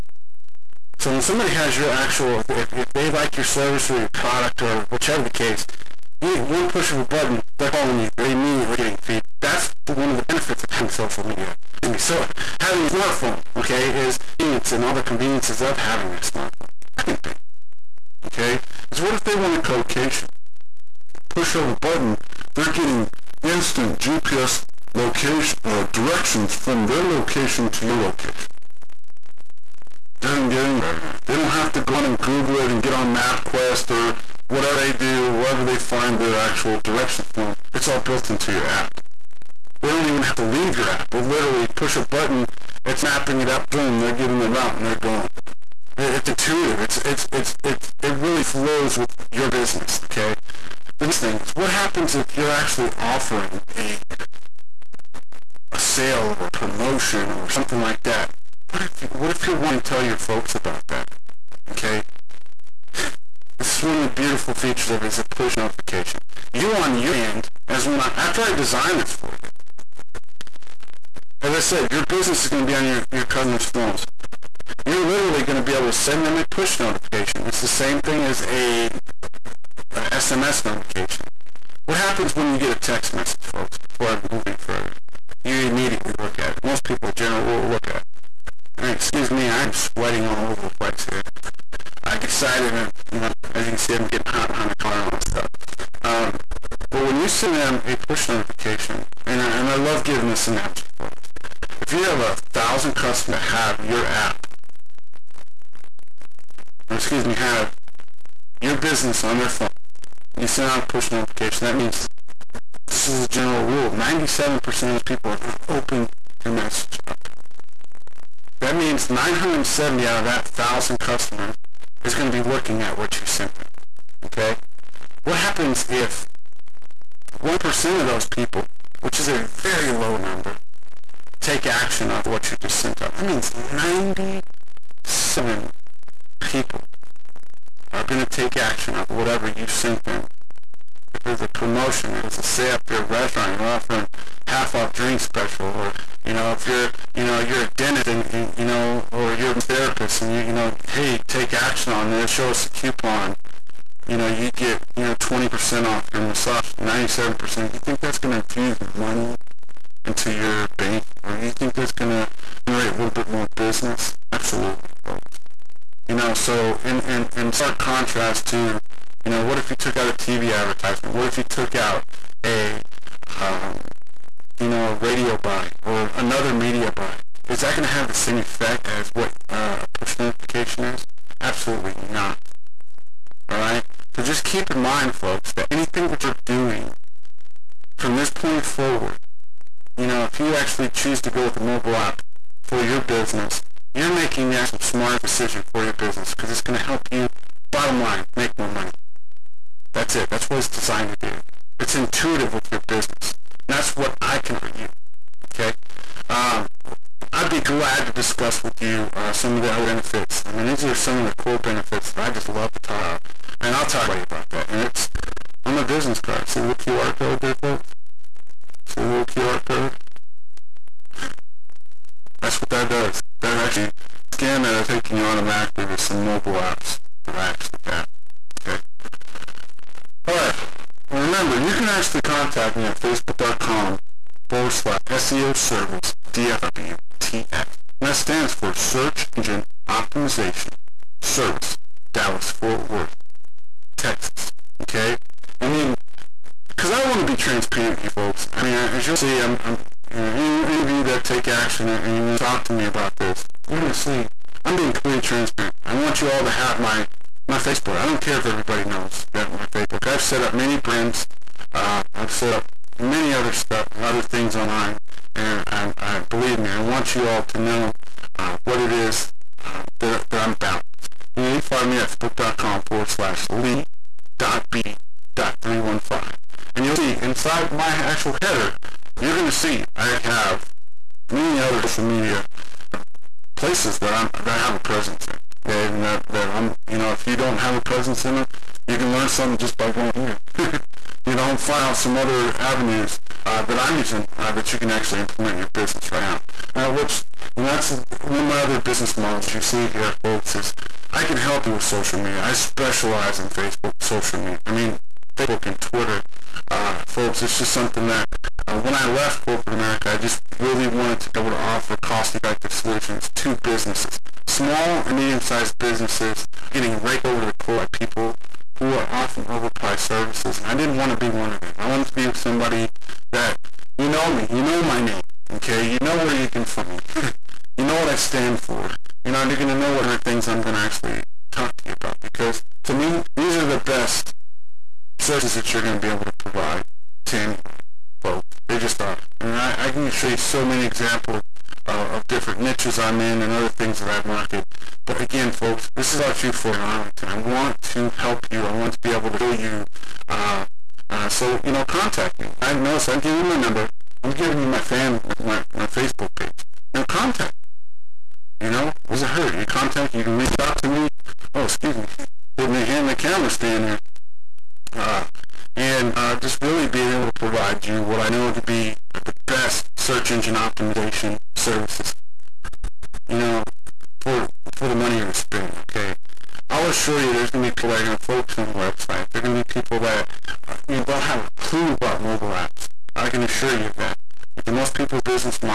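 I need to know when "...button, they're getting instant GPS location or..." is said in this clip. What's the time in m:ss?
0:21.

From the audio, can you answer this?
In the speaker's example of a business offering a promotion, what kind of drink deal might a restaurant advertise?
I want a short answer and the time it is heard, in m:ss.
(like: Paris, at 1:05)
half off drink special, at 2:24.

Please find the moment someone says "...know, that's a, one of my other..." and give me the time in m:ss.
4:57.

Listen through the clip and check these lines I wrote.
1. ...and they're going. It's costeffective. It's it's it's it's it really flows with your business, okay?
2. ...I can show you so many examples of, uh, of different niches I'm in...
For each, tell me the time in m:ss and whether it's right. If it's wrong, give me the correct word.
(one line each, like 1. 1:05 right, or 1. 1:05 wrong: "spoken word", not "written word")
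1. 0:44 wrong: "intuitive", not "costeffective"
2. 5:39 right.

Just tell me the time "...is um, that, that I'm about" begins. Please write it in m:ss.
4:28.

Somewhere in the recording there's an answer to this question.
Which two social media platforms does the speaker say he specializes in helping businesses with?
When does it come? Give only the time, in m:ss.
5:05.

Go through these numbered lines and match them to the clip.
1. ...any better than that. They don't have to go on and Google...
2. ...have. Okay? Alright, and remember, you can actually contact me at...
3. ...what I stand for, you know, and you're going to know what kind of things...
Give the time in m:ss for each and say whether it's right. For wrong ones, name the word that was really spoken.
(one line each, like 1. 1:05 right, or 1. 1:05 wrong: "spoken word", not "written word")
1. 0:30 right
2. 3:47 right
3. 5:27 right.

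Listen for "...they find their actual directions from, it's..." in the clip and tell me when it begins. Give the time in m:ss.
0:35.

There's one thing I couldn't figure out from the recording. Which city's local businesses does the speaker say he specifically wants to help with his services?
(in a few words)
Arlington.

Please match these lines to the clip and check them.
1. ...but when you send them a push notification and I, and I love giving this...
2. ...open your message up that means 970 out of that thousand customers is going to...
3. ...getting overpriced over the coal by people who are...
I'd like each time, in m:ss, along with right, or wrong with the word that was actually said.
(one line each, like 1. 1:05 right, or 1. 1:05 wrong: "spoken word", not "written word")
1. 1:36 right
2. 1:55 right
3. 5:16 wrong: "raked", not "overpriced".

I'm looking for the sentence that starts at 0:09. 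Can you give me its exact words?
That's one of the benefits of having social media.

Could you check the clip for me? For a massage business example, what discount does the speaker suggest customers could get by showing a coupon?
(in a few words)
20%.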